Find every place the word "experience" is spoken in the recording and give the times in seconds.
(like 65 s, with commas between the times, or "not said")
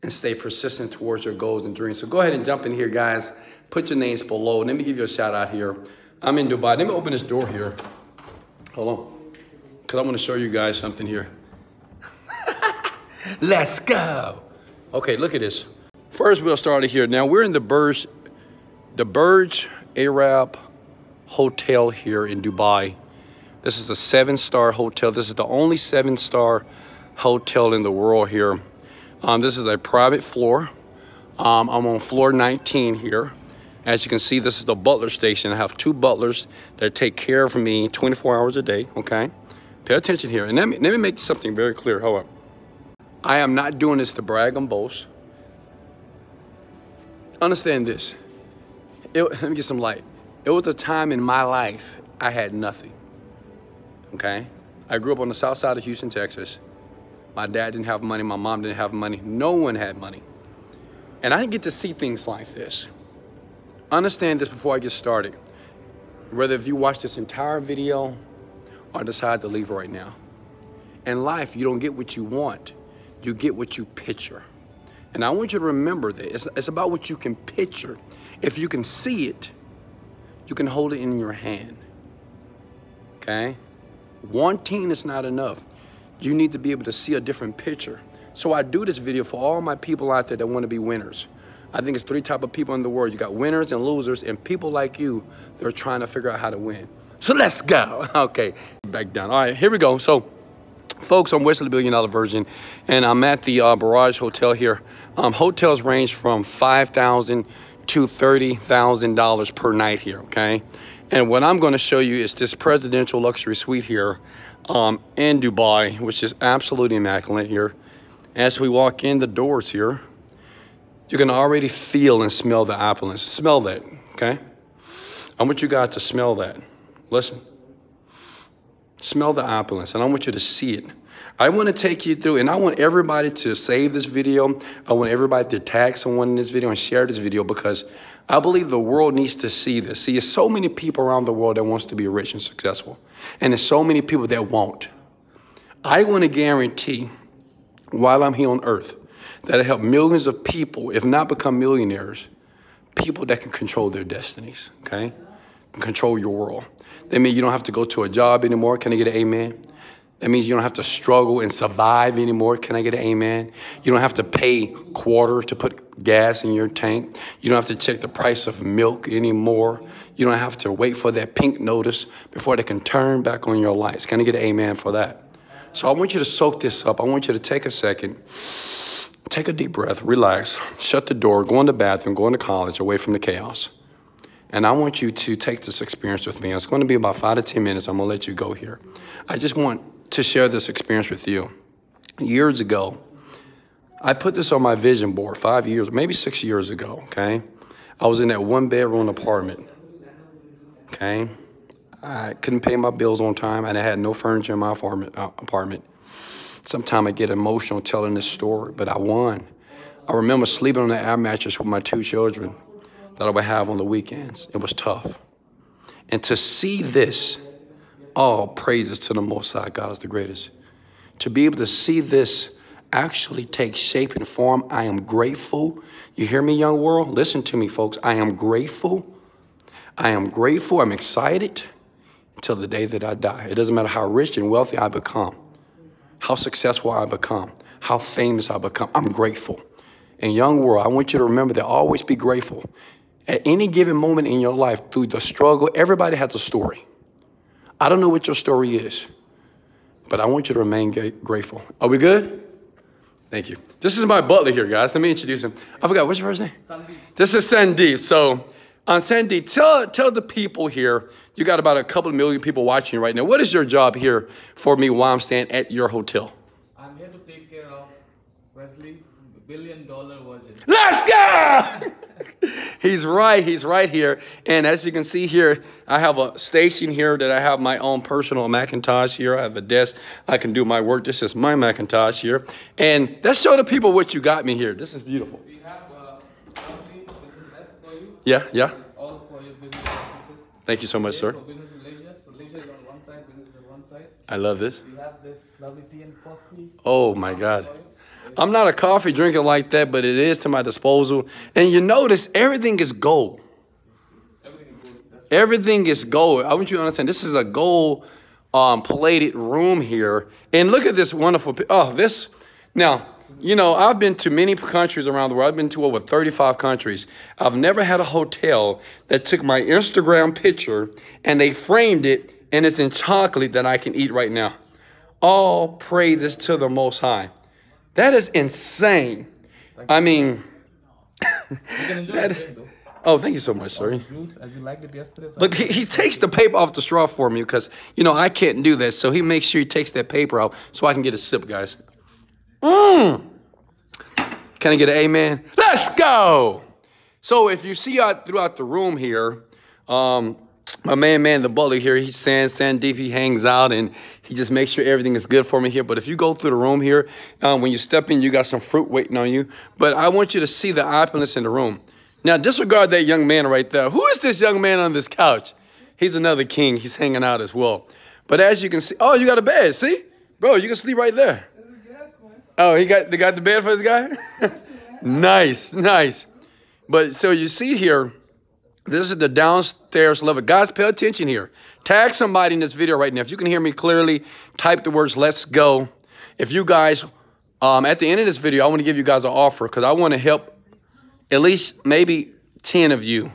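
185 s, 190 s.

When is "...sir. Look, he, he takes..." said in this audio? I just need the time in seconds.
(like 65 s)
333 s.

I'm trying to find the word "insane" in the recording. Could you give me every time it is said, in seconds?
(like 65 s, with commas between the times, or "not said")
328 s.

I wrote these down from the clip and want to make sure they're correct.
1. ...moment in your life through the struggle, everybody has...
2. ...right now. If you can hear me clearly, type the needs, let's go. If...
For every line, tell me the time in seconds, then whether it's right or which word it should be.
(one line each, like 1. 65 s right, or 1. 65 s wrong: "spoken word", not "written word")
1. 243 s right
2. 382 s wrong: "words", not "needs".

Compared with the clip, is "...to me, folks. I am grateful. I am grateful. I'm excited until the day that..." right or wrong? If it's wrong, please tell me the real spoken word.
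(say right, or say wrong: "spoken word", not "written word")
right.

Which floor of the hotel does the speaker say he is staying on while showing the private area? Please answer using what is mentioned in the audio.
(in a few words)
19.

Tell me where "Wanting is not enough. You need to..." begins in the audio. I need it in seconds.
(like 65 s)
84 s.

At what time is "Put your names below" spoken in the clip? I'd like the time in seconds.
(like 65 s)
3 s.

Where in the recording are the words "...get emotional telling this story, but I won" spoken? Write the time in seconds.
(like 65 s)
207 s.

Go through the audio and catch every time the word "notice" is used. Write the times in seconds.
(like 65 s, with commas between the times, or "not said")
171 s, 301 s.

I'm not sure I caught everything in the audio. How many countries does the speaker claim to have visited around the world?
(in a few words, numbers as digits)
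over 35.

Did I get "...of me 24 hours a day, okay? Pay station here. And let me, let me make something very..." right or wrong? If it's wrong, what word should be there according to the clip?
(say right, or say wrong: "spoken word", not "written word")
wrong: "attention", not "station".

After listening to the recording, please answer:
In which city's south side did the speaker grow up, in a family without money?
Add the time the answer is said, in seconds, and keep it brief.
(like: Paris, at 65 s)
Houston, Texas, at 55 s.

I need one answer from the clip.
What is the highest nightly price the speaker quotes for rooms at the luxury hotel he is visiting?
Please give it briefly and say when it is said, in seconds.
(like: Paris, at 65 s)
$30,000, at 108 s.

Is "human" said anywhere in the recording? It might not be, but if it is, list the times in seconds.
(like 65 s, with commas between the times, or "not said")
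not said.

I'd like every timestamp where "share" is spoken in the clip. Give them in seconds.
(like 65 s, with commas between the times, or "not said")
136 s, 190 s.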